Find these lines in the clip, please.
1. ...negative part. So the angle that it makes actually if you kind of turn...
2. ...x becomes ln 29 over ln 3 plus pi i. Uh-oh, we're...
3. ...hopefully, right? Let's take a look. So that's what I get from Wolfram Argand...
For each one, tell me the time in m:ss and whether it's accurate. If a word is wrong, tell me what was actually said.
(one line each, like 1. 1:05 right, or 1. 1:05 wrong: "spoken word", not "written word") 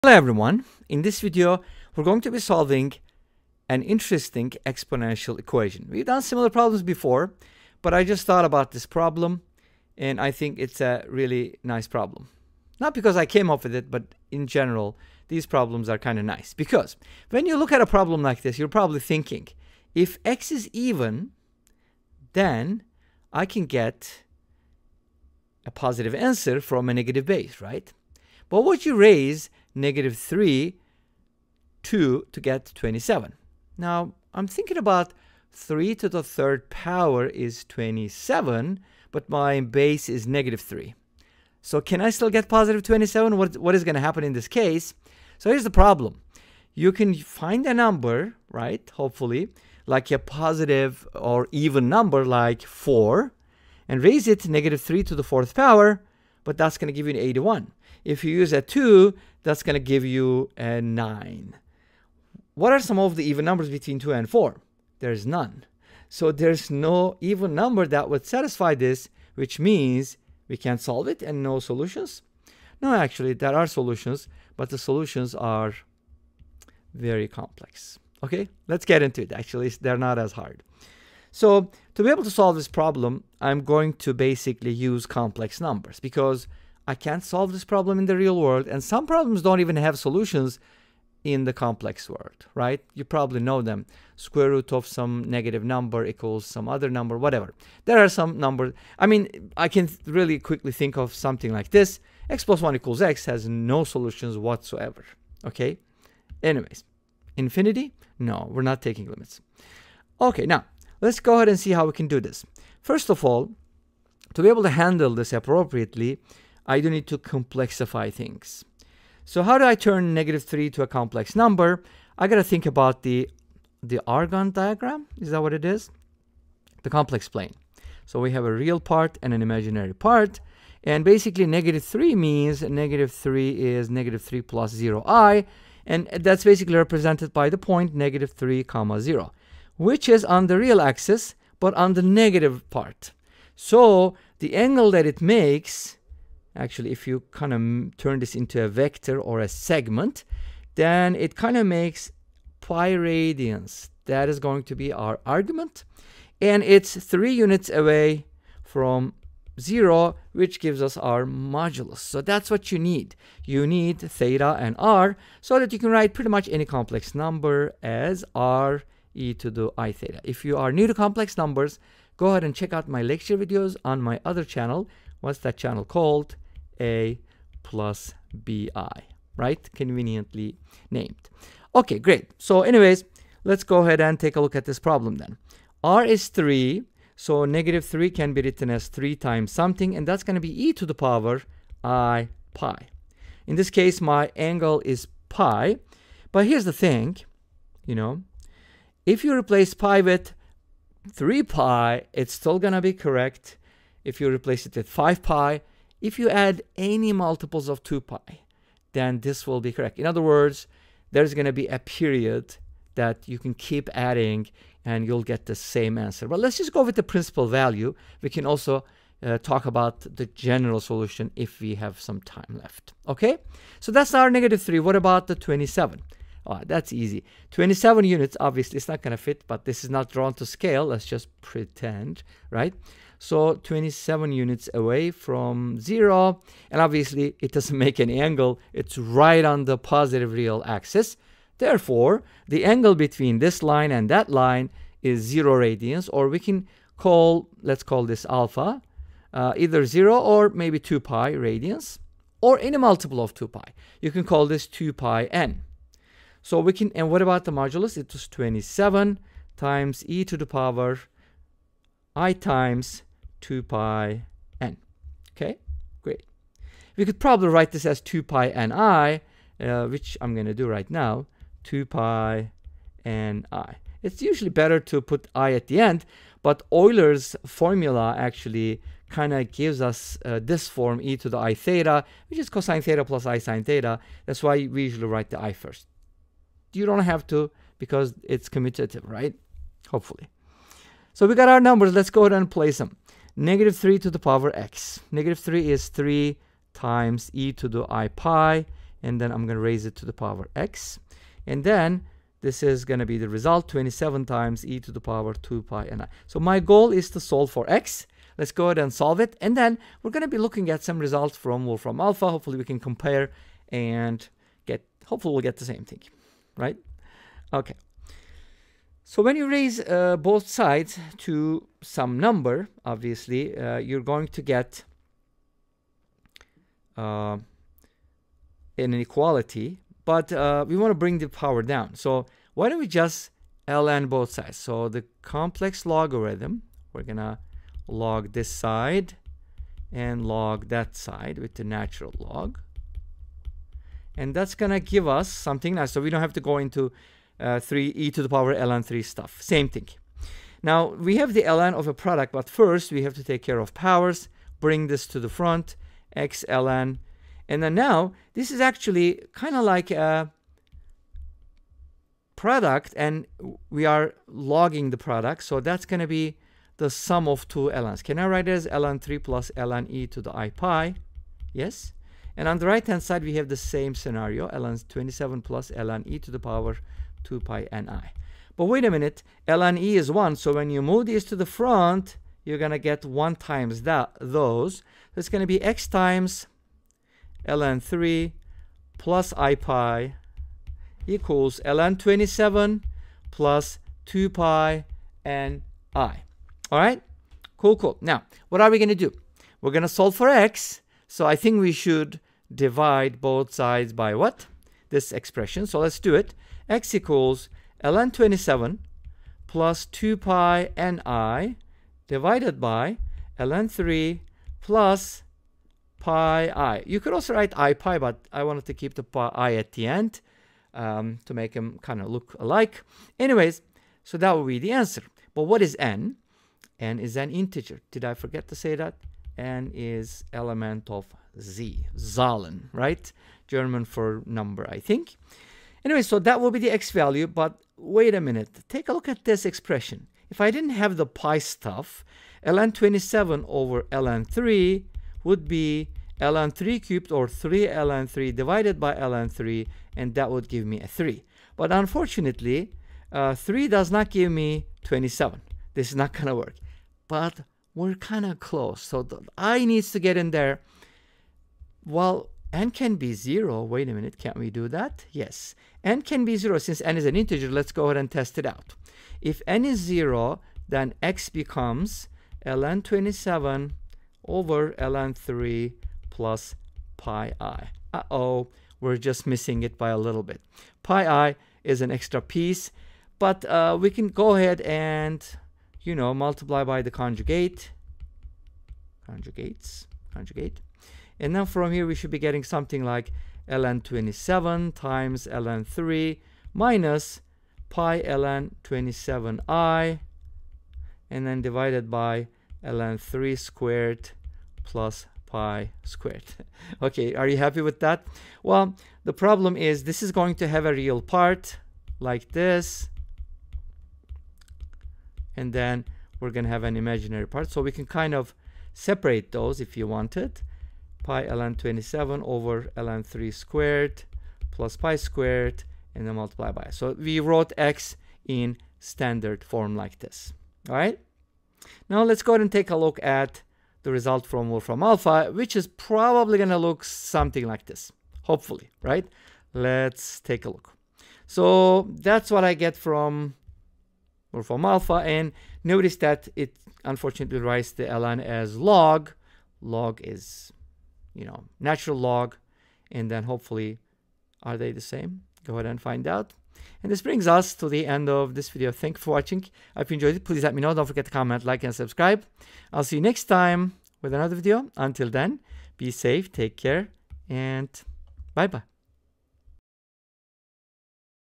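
1. 2:22 right
2. 7:51 wrong: "27", not "29"
3. 8:58 wrong: "Alpha", not "Argand".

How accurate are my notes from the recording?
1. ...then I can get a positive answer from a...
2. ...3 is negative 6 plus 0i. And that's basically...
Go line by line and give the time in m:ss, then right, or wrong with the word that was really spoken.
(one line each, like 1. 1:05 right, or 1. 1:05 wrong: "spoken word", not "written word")
1. 0:22 right
2. 2:13 wrong: "3", not "6".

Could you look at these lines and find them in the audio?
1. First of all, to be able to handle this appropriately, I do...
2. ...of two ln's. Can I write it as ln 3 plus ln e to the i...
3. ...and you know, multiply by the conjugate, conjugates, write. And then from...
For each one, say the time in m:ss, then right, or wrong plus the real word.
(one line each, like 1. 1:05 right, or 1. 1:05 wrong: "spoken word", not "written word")
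1. 1:52 right
2. 6:07 right
3. 8:04 wrong: "conjugate", not "write".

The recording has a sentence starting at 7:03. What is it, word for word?
Anyways, so that would be the answer.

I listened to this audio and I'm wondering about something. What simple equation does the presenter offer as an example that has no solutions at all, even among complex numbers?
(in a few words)
x + 1 = x.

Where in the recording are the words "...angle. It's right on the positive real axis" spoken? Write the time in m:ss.
3:58.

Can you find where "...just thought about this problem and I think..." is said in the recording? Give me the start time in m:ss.
0:08.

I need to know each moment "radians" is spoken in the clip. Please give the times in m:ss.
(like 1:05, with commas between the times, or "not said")
2:32, 4:05, 4:11.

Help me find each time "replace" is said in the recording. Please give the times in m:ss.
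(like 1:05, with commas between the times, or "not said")
3:19, 3:24.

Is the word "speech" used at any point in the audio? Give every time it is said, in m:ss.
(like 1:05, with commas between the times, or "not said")
not said.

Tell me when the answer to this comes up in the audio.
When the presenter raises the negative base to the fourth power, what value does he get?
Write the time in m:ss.
0:57.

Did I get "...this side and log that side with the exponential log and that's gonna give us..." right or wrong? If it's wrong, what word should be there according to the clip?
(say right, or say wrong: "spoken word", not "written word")
wrong: "natural", not "exponential".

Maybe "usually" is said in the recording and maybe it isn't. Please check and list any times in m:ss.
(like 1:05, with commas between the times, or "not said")
4:34, 4:44.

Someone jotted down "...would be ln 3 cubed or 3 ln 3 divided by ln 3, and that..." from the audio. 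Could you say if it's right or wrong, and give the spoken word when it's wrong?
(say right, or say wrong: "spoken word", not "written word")
right.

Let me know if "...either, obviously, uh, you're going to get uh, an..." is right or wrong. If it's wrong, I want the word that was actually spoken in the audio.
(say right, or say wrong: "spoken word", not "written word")
wrong: "number", not "either".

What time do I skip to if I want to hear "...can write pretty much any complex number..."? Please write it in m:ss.
2:45.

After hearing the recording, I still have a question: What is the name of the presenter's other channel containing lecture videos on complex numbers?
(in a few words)
a plus bi.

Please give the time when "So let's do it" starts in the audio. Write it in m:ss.
6:45.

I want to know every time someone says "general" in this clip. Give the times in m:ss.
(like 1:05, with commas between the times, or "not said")
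0:14, 3:40.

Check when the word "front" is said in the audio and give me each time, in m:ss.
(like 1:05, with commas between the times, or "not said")
5:55, 6:21.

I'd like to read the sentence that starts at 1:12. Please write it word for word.
No, actually, there are solutions, but the solutions are very complex.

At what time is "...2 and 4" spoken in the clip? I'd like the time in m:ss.
1:03.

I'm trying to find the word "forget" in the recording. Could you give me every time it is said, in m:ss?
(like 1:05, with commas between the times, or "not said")
7:08, 9:20.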